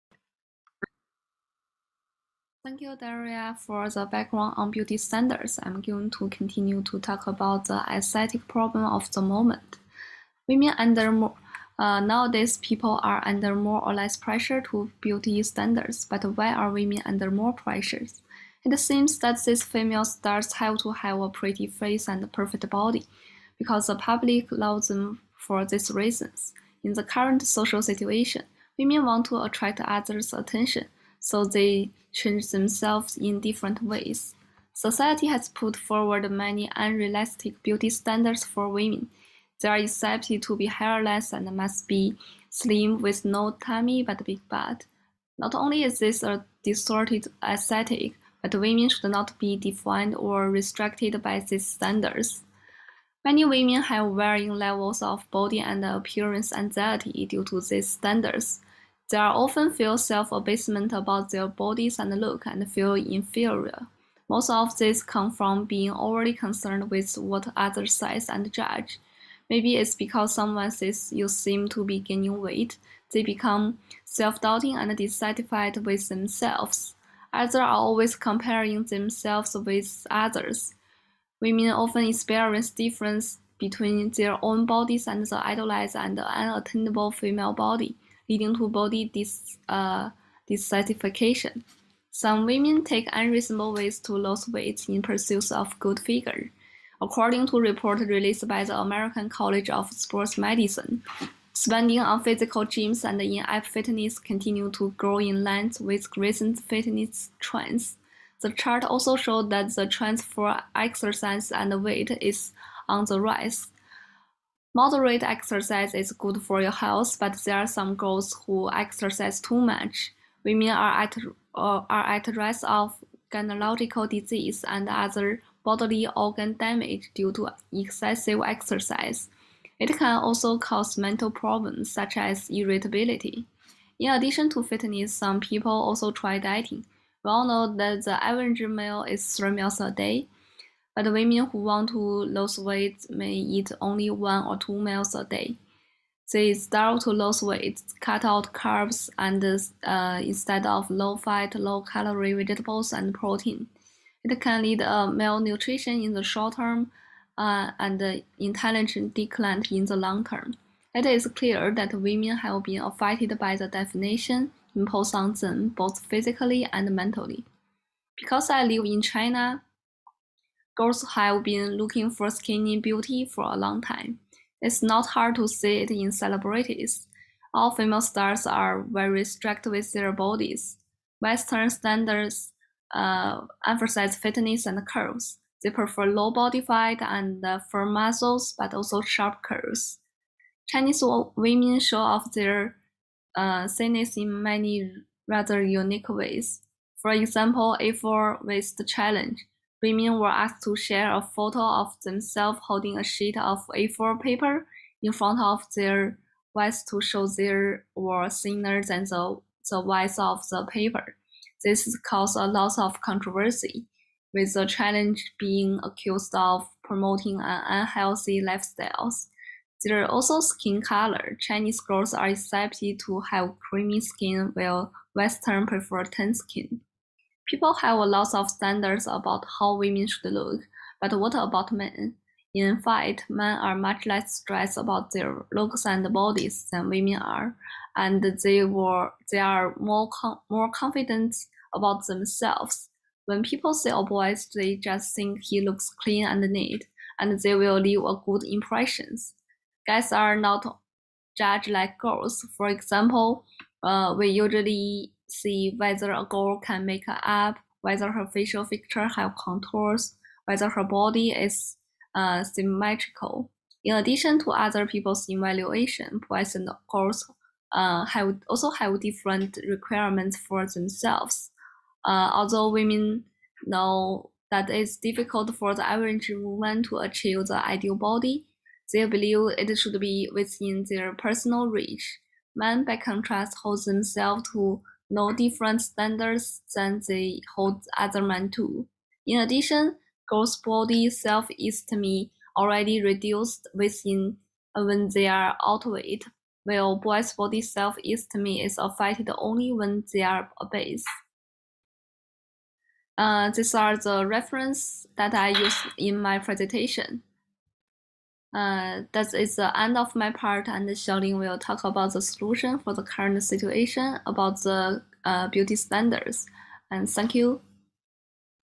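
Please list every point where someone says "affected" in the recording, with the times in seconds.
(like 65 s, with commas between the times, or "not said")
162 s, 298 s.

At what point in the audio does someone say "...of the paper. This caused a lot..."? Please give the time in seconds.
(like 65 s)
210 s.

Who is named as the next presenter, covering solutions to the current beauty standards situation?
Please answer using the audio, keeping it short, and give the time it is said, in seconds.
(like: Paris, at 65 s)
Xiaolin, at 310 s.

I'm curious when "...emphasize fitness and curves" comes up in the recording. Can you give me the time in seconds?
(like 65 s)
183 s.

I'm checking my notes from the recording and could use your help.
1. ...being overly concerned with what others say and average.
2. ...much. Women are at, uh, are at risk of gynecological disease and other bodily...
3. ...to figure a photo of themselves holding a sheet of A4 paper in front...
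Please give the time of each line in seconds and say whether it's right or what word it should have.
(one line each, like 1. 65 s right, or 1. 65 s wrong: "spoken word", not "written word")
1. 65 s wrong: "judge", not "average"
2. 119 s right
3. 200 s wrong: "share", not "figure".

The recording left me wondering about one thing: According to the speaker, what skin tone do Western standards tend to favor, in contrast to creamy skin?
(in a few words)
Tan skin.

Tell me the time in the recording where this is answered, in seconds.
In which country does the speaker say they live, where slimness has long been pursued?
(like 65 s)
169 s.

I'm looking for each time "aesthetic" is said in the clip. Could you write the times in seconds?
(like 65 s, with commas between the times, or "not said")
7 s, 47 s.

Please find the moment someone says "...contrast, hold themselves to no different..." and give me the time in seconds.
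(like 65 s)
282 s.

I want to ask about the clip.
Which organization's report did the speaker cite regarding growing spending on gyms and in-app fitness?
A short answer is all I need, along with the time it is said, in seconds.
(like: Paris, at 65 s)
American College of Sports Medicine, at 98 s.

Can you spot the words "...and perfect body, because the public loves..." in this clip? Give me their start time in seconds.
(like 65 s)
22 s.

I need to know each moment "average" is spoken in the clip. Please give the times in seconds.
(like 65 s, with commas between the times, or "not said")
138 s, 275 s.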